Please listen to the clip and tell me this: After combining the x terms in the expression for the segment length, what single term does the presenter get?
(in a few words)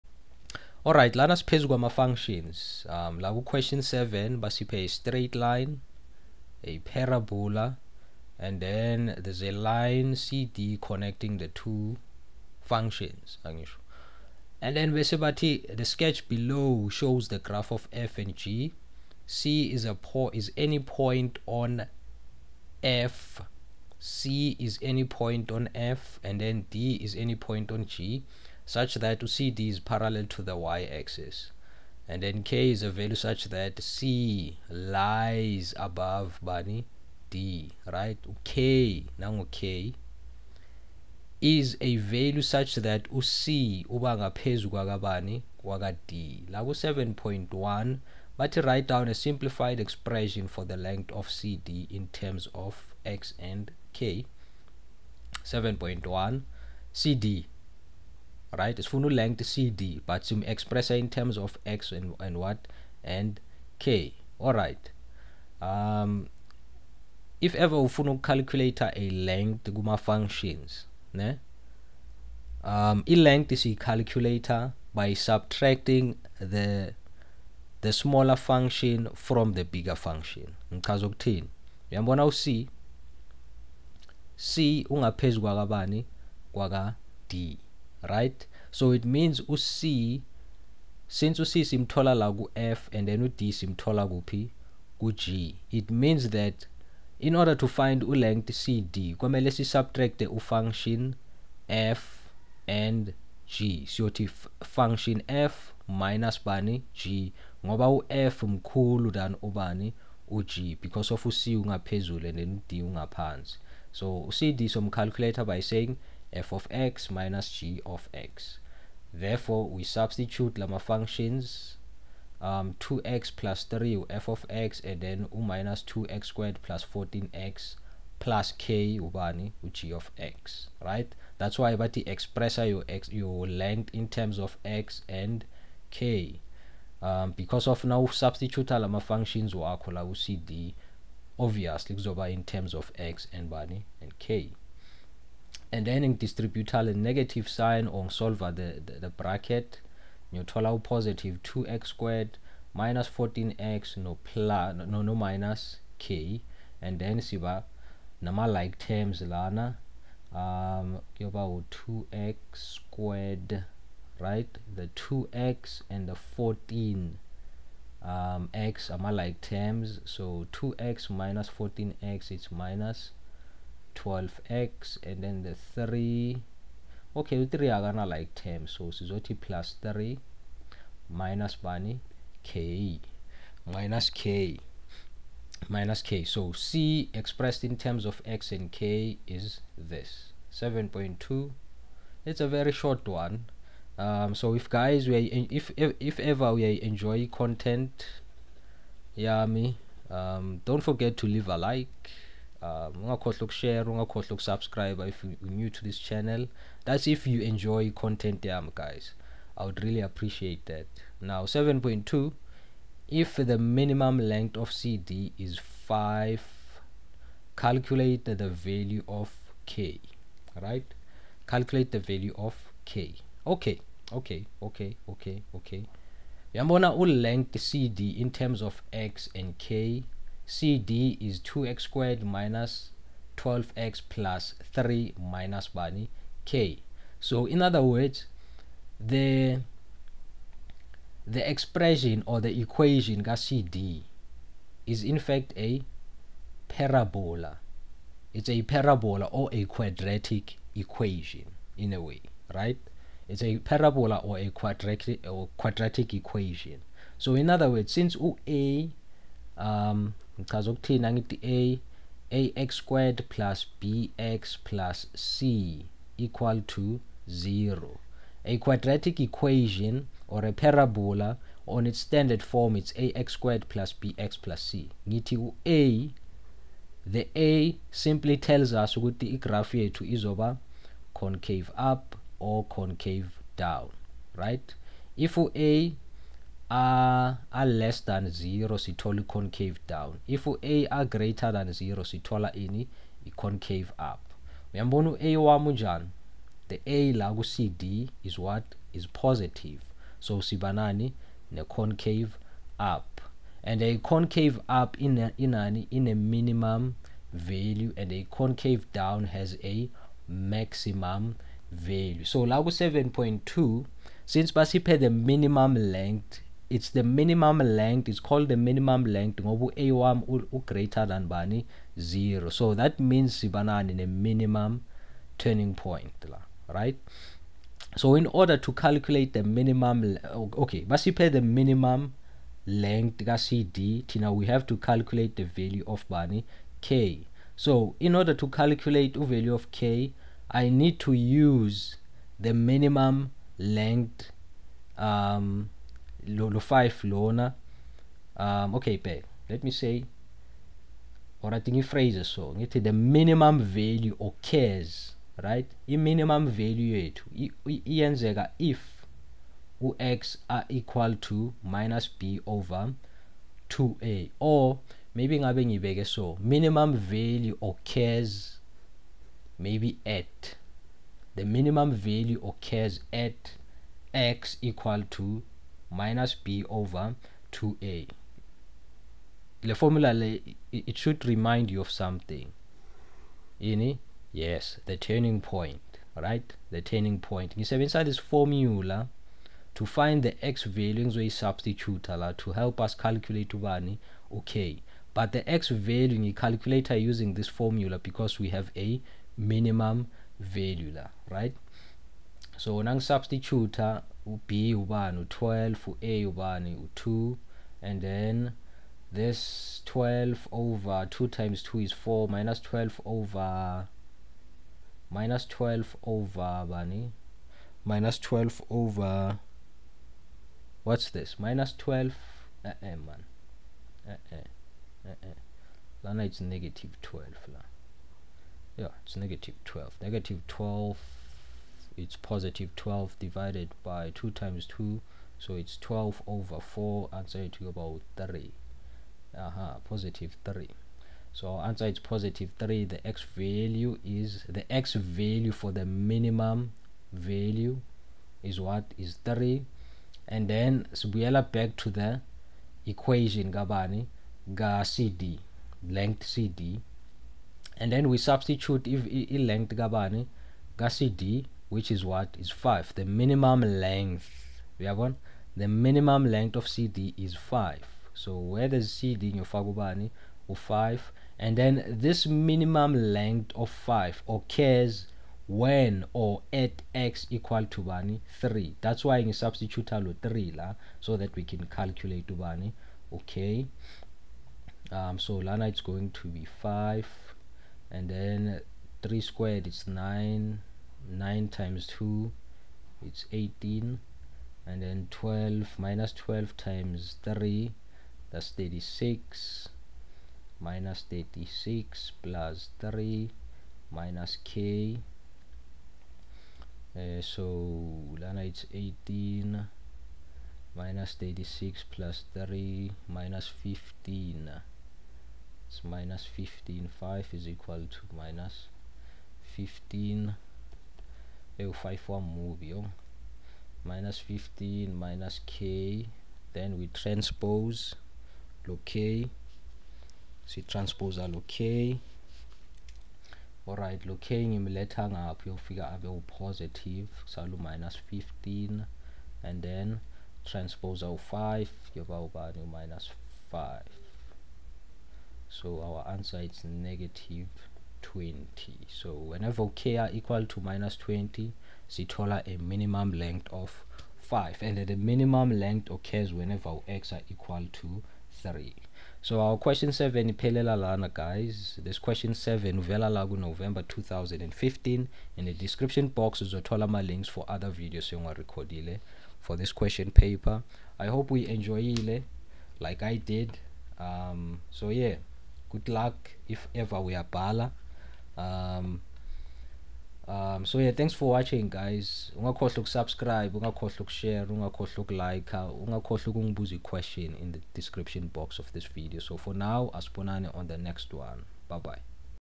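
-12x.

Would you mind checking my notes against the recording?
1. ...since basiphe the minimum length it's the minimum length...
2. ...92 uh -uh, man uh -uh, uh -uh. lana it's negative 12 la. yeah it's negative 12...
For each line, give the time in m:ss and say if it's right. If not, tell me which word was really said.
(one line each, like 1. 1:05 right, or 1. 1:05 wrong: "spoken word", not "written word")
1. 5:14 right
2. 7:01 wrong: "12", not "92".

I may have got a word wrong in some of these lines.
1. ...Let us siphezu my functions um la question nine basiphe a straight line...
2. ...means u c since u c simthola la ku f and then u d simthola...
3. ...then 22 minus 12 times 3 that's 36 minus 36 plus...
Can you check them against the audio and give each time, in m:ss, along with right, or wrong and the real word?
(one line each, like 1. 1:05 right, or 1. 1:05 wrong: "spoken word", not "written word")
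1. 0:01 wrong: "seven", not "nine"
2. 1:29 right
3. 8:14 wrong: "12", not "22".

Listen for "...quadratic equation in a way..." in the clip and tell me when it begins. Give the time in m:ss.
4:09.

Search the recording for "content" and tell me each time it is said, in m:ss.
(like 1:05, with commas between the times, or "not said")
3:17, 3:27.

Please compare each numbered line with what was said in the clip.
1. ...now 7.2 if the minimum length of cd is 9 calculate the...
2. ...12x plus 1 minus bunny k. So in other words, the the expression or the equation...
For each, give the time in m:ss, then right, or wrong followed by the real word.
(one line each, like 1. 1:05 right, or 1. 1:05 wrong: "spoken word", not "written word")
1. 3:31 wrong: "5", not "9"
2. 3:53 wrong: "3", not "1".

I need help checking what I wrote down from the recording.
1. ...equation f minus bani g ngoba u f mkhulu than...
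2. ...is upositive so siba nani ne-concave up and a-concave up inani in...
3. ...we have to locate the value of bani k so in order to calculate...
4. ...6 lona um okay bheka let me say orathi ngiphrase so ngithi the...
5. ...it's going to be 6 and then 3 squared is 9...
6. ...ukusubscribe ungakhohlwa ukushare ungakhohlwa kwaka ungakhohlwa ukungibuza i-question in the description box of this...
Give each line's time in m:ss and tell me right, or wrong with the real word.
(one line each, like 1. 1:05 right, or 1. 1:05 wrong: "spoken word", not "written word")
1. 1:44 wrong: "function", not "equation"
2. 4:58 wrong: "positive", not "upositive"
3. 5:34 wrong: "calculate", not "locate"
4. 5:46 wrong: "5", not "6"
5. 8:05 wrong: "5", not "6"
6. 9:42 wrong: "ukulika", not "kwaka".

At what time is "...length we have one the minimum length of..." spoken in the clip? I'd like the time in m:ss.
7:43.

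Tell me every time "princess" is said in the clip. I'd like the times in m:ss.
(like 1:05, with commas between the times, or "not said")
not said.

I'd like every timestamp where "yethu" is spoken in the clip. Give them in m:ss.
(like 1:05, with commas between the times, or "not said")
4:39, 5:56.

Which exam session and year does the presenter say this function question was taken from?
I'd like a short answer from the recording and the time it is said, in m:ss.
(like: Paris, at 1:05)
November 2015, at 9:23.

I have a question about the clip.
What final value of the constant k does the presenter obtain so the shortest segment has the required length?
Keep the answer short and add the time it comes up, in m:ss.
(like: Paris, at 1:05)
-20, at 9:06.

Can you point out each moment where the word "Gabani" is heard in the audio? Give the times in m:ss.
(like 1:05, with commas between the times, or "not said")
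7:33, 7:39.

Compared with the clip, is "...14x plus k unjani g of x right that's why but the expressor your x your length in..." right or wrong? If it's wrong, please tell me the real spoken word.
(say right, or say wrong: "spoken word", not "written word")
wrong: "ubani", not "unjani".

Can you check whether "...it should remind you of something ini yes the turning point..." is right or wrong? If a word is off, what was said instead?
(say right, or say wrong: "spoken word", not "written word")
right.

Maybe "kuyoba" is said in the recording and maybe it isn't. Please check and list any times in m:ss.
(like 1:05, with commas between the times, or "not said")
2:41.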